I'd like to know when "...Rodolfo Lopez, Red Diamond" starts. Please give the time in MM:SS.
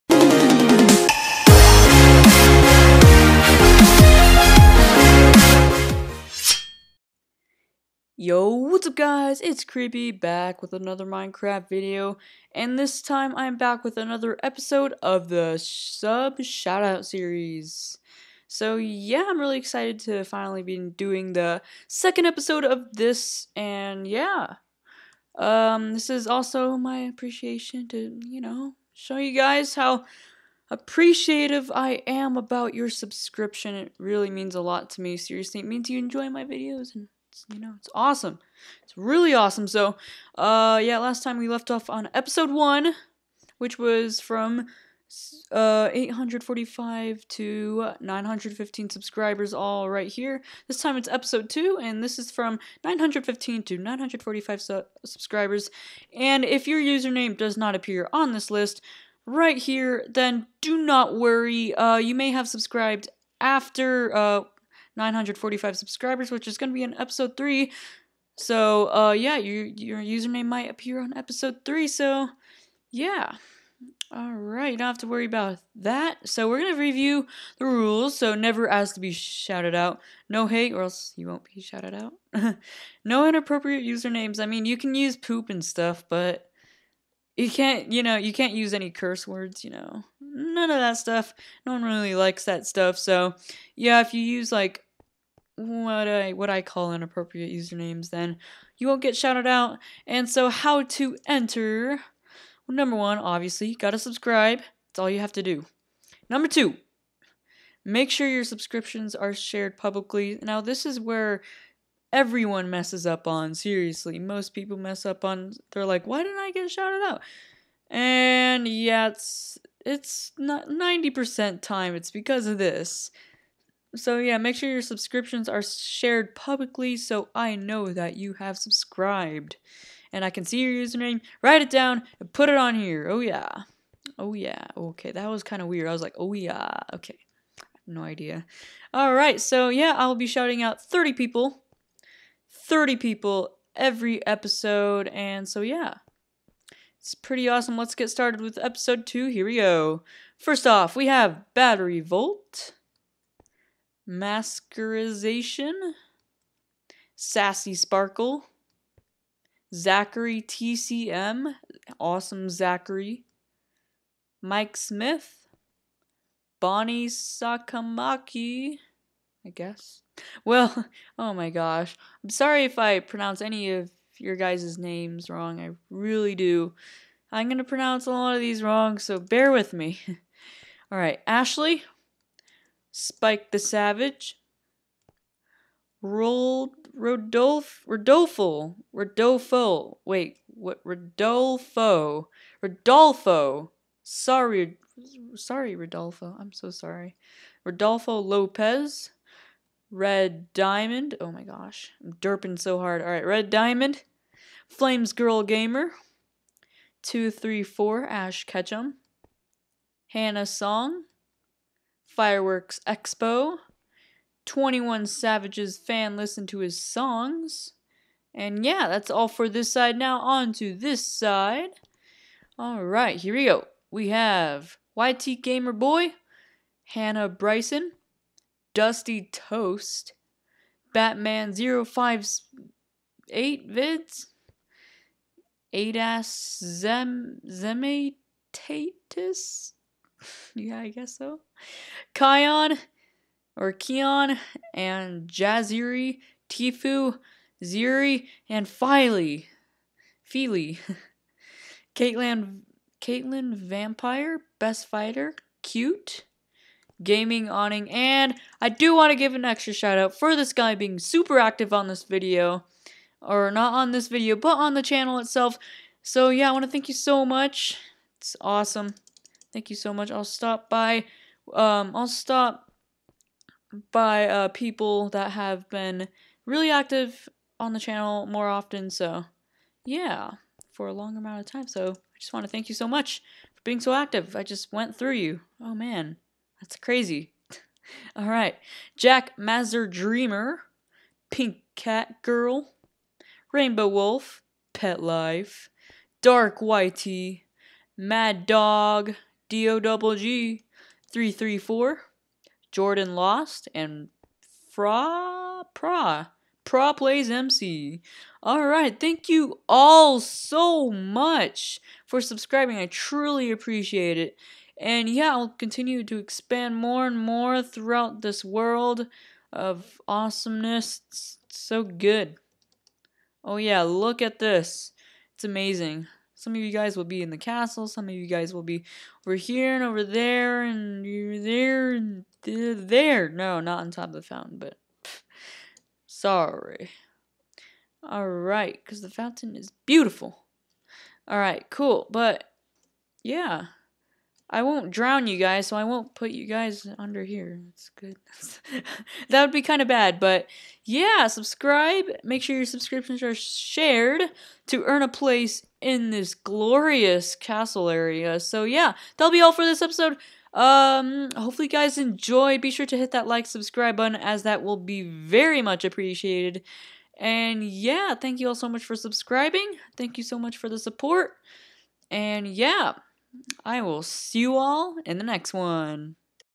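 03:17.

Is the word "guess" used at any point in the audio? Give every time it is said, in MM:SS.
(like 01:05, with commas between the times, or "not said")
02:49, 04:00.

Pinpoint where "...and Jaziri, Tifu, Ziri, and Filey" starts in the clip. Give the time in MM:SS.
04:04.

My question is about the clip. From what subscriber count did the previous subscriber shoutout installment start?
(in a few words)
845.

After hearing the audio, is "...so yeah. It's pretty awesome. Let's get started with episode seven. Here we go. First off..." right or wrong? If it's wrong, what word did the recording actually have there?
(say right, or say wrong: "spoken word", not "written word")
wrong: "two", not "seven".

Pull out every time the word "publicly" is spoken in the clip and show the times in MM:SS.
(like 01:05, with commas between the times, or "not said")
01:49, 02:06.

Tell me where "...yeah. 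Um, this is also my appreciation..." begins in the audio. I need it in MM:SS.
00:24.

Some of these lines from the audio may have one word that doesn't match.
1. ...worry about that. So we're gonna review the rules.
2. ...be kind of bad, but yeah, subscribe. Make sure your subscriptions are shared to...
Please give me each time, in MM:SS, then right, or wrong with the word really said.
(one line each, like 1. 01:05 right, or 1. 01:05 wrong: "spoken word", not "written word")
1. 01:15 right
2. 05:49 right.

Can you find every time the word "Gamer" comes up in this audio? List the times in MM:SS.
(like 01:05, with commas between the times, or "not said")
03:25, 03:45.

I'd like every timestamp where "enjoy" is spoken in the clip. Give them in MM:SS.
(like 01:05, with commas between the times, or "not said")
00:35, 06:01.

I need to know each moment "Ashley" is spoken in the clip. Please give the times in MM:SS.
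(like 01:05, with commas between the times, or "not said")
03:01.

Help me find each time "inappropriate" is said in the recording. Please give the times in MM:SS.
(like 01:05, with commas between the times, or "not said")
01:23, 01:36.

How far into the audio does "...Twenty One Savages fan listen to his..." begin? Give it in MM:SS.
03:34.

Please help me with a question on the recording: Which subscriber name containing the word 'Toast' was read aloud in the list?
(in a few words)
Dusty Toast.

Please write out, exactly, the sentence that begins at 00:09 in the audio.
It's Creepy back with another Minecraft video, and this time I'm back with another episode of the sub shoutout series.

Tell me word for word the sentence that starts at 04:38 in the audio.
So yeah, for a long amount of time.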